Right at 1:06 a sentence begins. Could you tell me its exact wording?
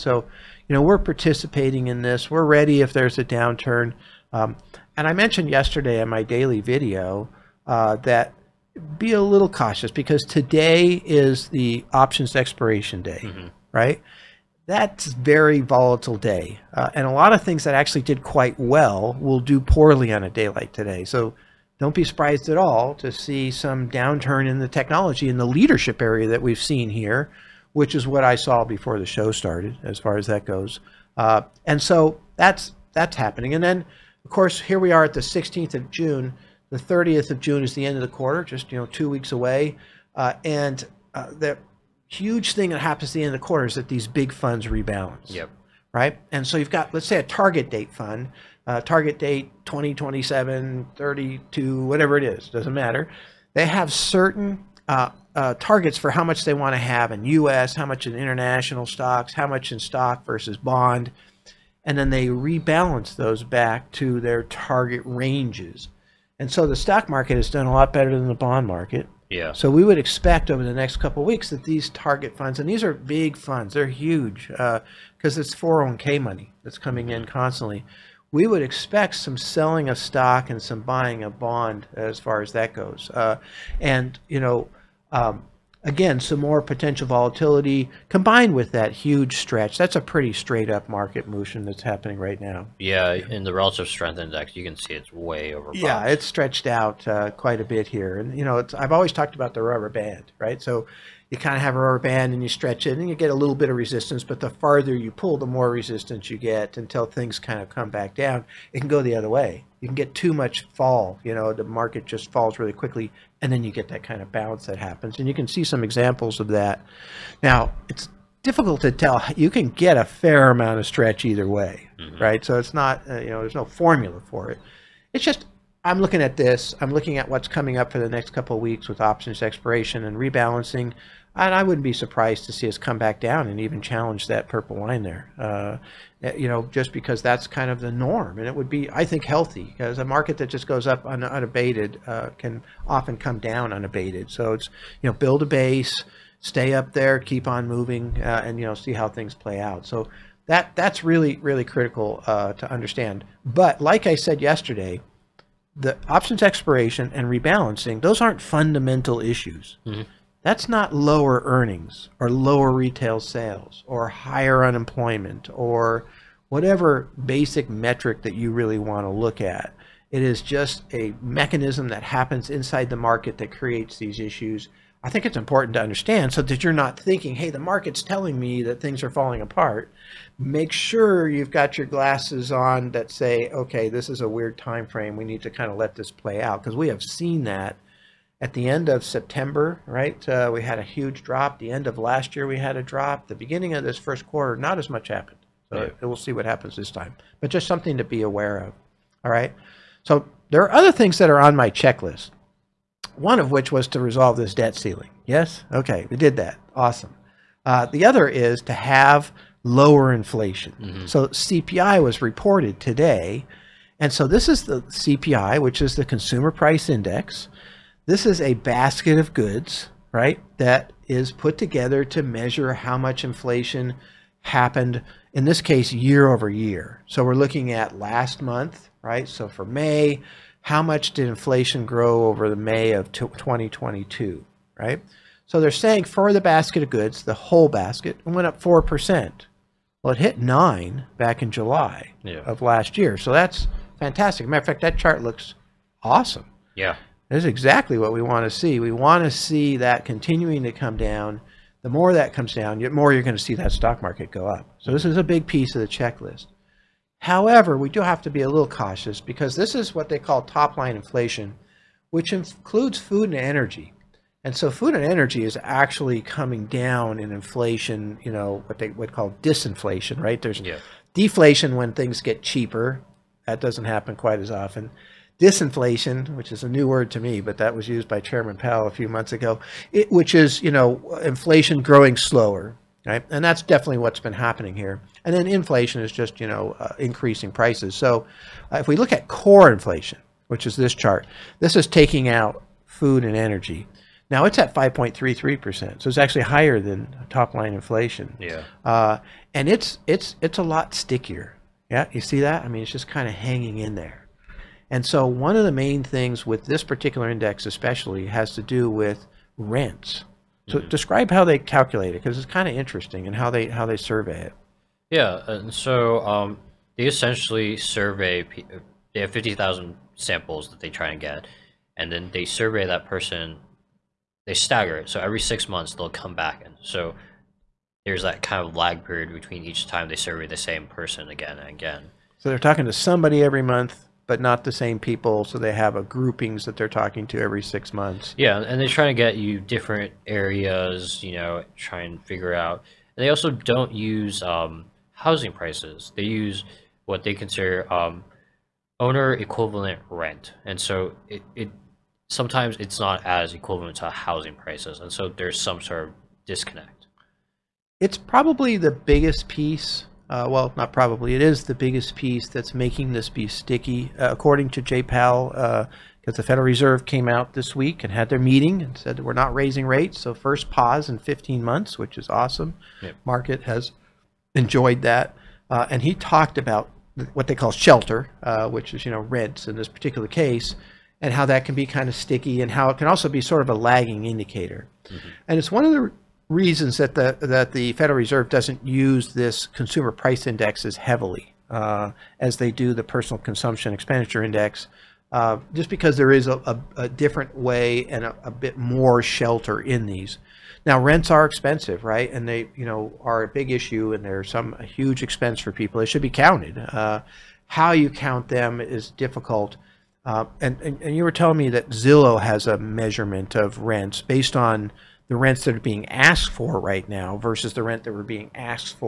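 And so the stock market has done a lot better than the bond market.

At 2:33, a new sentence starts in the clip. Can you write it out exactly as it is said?
But like I said yesterday, the options expiration and rebalancing, those aren't fundamental issues.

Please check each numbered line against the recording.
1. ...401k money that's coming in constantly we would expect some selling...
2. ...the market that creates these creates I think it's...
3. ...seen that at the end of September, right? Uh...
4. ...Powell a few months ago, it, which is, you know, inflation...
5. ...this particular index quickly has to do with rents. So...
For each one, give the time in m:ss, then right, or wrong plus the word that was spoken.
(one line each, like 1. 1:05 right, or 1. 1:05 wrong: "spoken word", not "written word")
1. 1:15 right
2. 2:52 wrong: "issues", not "creates"
3. 3:07 right
4. 4:38 right
5. 5:06 wrong: "especially", not "quickly".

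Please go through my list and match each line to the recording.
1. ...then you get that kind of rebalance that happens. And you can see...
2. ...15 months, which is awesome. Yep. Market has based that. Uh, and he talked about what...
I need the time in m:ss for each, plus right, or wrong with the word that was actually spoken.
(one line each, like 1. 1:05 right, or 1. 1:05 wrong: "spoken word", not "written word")
1. 1:53 wrong: "bounce", not "rebalance"
2. 6:11 wrong: "enjoyed", not "based".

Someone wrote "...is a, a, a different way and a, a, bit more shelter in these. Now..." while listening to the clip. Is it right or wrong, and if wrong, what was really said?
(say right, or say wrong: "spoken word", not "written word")
right.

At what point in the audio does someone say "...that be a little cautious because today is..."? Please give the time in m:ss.
0:07.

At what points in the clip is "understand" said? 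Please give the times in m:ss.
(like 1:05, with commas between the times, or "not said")
2:32, 2:55.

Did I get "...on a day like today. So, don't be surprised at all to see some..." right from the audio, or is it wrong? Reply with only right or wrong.
right.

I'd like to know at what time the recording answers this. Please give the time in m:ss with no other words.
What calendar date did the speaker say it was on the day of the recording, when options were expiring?
0:35.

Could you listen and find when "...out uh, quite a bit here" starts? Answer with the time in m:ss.
1:36.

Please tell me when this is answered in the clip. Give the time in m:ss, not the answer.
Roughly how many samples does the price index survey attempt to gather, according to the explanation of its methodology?
5:19.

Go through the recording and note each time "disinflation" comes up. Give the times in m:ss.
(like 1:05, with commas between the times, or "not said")
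4:29, 4:35.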